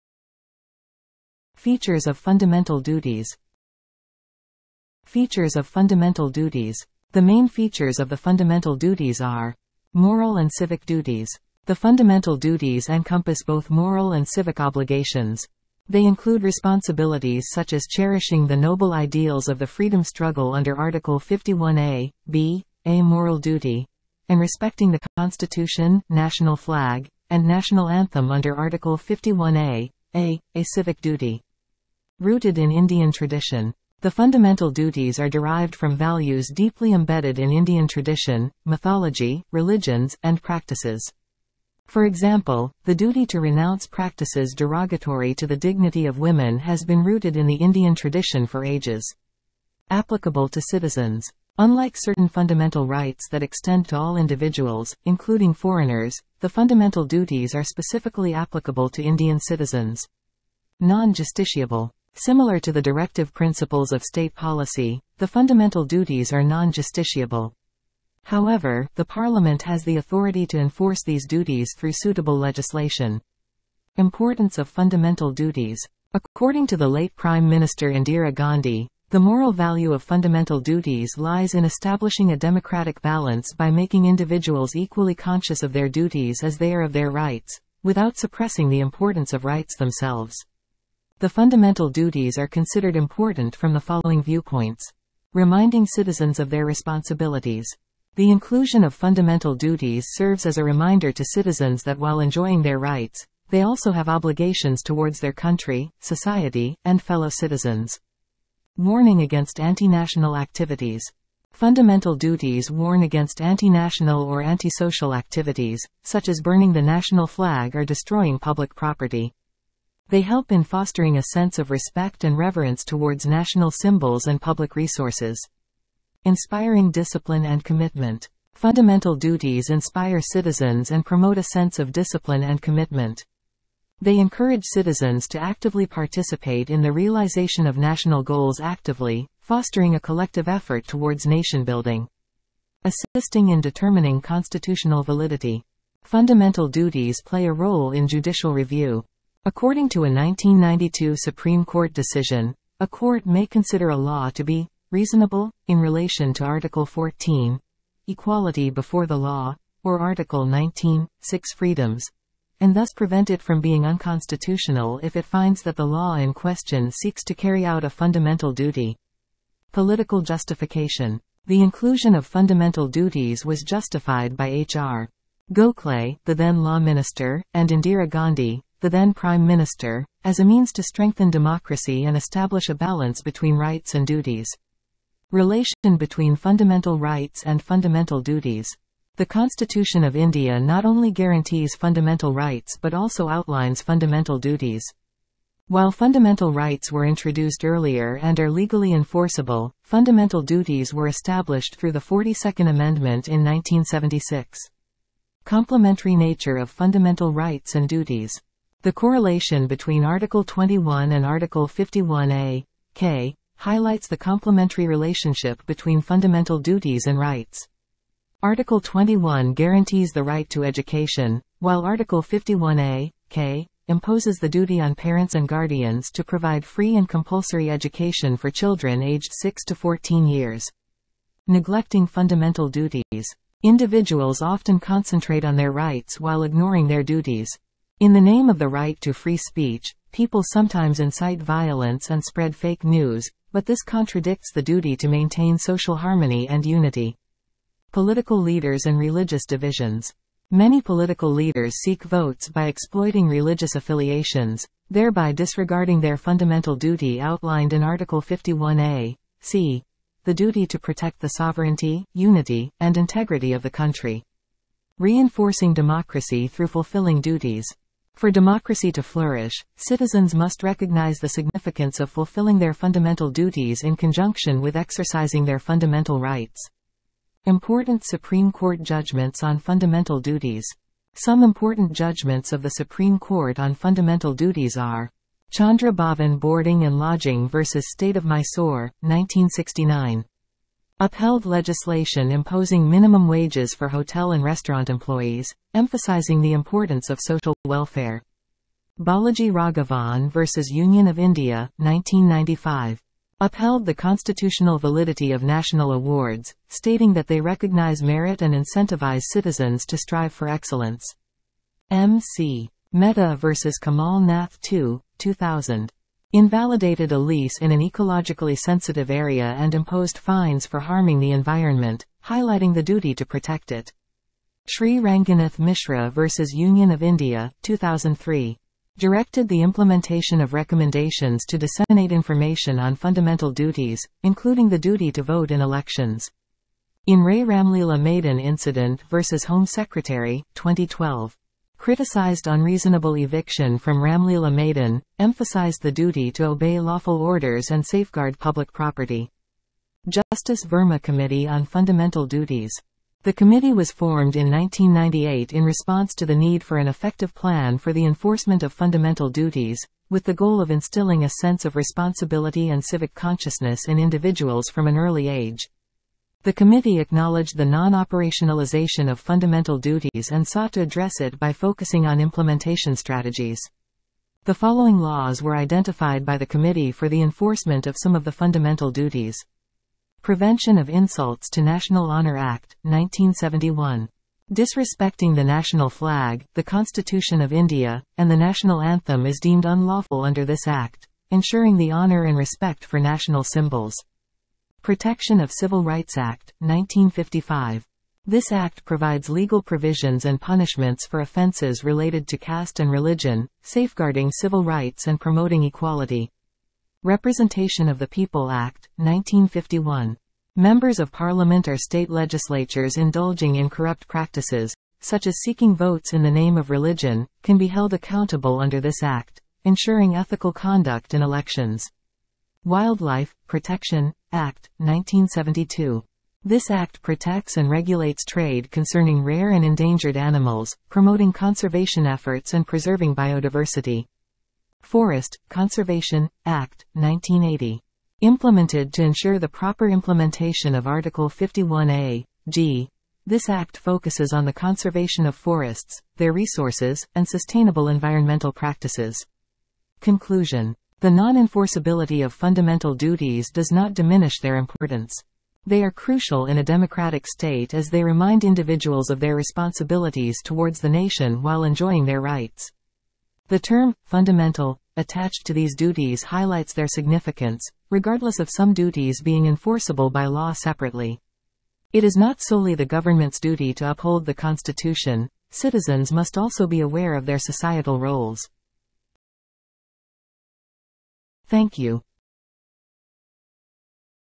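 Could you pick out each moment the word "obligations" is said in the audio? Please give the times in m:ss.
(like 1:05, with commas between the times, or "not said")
0:14, 1:44.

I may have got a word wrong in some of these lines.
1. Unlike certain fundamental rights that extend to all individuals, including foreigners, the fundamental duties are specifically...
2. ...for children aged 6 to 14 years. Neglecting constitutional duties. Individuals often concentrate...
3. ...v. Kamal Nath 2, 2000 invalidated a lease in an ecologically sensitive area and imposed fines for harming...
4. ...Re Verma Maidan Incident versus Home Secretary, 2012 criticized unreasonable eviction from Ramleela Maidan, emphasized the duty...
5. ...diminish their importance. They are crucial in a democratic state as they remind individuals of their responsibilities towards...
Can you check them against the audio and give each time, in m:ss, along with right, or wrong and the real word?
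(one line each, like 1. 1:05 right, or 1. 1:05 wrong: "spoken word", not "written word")
1. 0:51 right
2. 3:48 wrong: "fundamental", not "constitutional"
3. 5:13 right
4. 5:37 wrong: "Ramlila", not "Verma"
5. 7:33 right.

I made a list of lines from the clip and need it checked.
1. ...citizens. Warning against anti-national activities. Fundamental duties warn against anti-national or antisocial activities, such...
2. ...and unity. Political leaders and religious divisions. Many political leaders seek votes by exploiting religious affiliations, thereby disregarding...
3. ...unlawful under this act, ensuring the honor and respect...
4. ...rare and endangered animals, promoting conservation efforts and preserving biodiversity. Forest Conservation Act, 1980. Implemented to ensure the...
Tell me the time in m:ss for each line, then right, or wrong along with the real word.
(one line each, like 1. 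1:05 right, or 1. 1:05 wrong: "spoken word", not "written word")
1. 1:47 right
2. 4:06 right
3. 6:29 right
4. 7:09 right.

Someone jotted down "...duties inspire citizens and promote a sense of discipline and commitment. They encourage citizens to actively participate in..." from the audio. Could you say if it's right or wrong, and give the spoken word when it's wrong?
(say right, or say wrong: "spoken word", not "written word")
right.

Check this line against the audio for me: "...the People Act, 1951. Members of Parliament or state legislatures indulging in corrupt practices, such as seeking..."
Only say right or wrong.
right.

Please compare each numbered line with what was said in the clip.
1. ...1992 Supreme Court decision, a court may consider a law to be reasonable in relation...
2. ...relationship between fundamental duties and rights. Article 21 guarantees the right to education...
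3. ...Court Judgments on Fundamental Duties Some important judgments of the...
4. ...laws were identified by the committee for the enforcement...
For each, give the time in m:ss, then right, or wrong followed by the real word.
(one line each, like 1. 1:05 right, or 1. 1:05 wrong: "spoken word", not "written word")
1. 2:30 right
2. 3:34 right
3. 4:38 right
4. 6:14 right.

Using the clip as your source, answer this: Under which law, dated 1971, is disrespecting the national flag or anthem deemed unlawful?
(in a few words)
Prevention of Insults to National Honor Act.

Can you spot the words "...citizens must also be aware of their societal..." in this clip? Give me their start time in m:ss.
7:55.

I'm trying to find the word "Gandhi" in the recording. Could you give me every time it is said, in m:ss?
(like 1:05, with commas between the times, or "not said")
1:18, 2:58.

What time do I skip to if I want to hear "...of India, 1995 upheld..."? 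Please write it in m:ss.
5:01.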